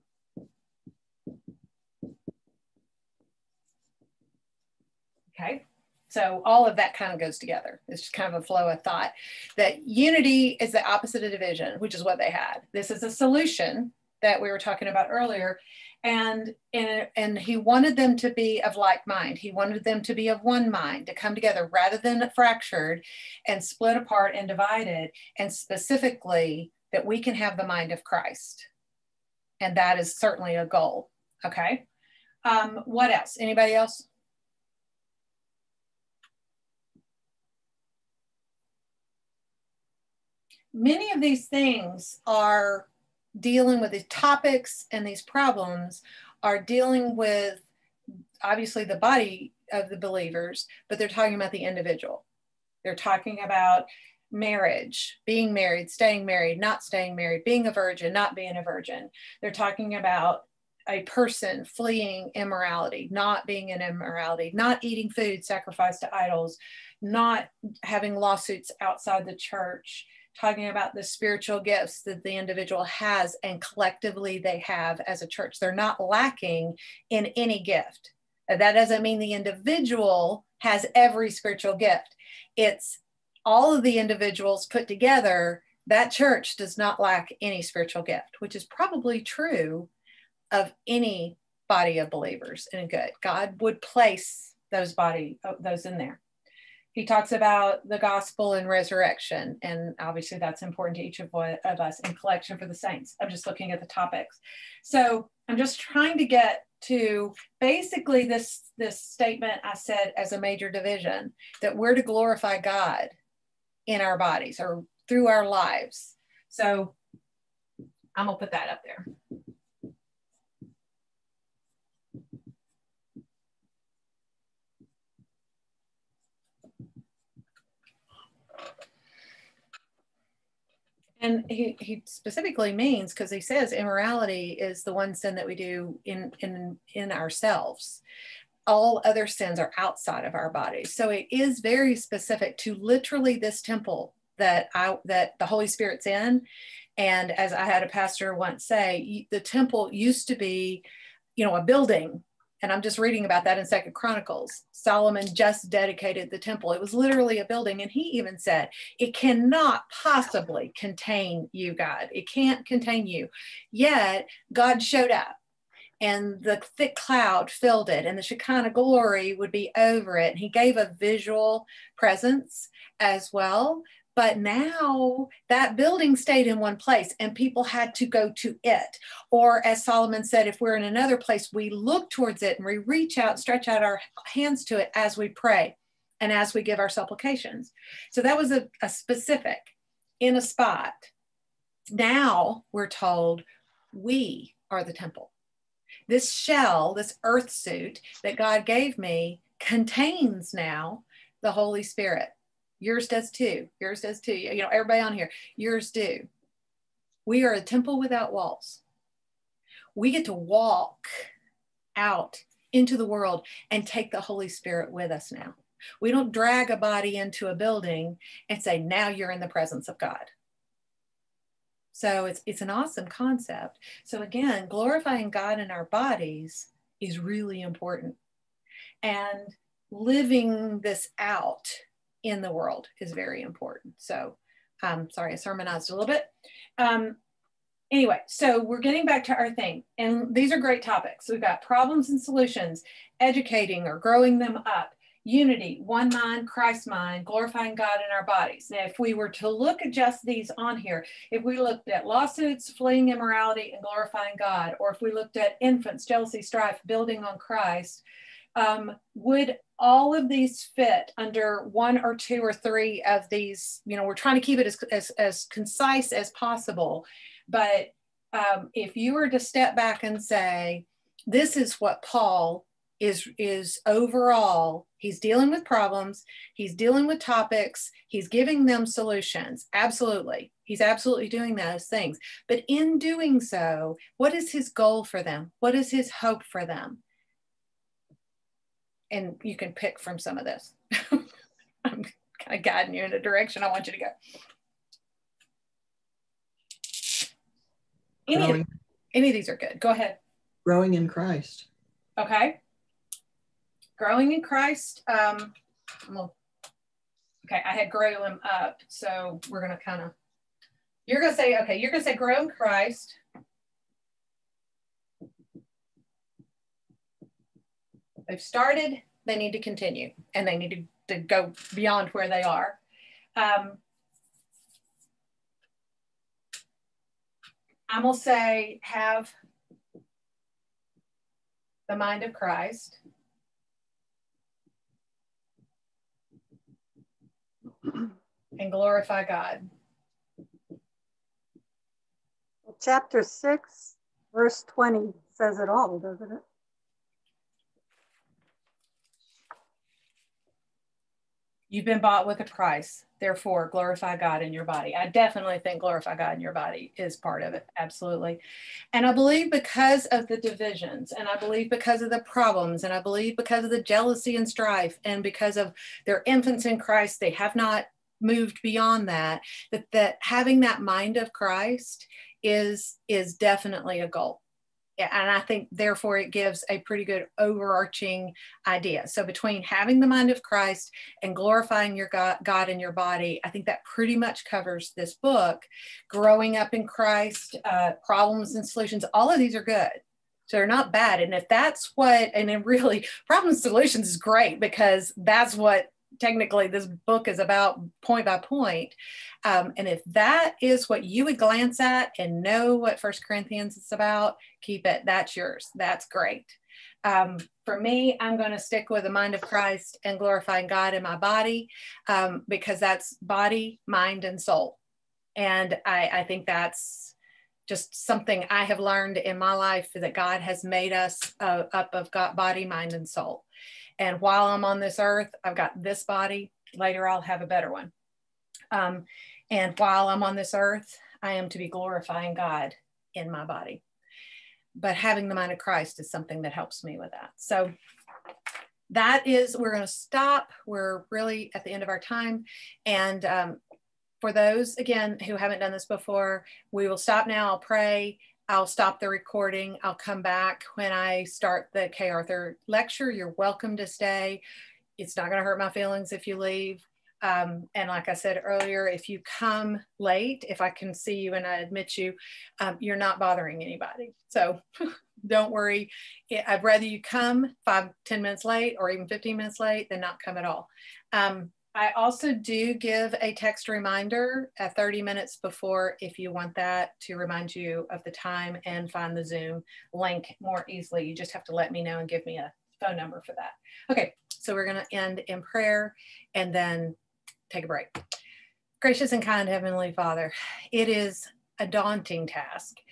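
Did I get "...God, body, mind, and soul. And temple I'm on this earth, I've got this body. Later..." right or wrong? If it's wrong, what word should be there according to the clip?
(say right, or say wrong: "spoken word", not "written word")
wrong: "while", not "temple".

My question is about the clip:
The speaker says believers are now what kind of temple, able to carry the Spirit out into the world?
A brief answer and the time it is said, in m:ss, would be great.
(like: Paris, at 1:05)
a temple without walls, at 3:27.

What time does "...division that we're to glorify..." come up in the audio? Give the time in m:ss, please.
1:50.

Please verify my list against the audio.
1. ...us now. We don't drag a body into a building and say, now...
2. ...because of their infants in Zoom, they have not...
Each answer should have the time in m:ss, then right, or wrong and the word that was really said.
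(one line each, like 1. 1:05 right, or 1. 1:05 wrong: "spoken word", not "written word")
1. 3:35 right
2. 6:05 wrong: "Christ", not "Zoom".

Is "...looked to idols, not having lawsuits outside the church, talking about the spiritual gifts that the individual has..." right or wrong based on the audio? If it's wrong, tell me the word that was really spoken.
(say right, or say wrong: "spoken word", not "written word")
wrong: "sacrificed", not "looked".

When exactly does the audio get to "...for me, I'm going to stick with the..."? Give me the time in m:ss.
6:47.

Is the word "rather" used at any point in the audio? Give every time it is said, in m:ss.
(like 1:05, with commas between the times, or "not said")
0:21, 7:46.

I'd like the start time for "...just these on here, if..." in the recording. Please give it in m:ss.
4:09.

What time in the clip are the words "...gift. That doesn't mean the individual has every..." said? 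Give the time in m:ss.
1:17.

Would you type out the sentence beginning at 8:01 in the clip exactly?
You just have to let me know and give me a phone number for that.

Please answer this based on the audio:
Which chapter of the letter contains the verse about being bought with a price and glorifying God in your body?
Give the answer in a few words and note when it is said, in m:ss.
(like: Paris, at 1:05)
Chapter 6, at 5:42.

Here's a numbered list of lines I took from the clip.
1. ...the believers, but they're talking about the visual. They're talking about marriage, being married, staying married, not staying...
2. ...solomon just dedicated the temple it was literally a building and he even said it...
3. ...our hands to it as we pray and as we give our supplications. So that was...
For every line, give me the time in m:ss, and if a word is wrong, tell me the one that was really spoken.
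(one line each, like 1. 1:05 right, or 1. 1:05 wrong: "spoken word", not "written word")
1. 0:49 wrong: "individual", not "visual"
2. 2:34 right
3. 3:03 right.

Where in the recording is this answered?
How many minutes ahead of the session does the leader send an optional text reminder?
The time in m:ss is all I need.
7:54.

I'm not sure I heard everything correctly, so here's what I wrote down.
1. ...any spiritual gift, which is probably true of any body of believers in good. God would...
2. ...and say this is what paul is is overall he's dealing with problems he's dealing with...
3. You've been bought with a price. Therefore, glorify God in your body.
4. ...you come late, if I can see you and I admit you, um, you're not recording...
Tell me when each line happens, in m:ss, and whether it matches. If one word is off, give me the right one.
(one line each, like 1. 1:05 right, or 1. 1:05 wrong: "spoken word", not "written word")
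1. 1:27 right
2. 4:30 right
3. 5:51 right
4. 7:39 wrong: "bothering", not "recording".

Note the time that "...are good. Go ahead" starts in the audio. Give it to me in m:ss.
4:59.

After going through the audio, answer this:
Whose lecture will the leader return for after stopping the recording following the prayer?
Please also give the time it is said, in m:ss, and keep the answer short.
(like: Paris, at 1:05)
Kay Arthur, at 7:31.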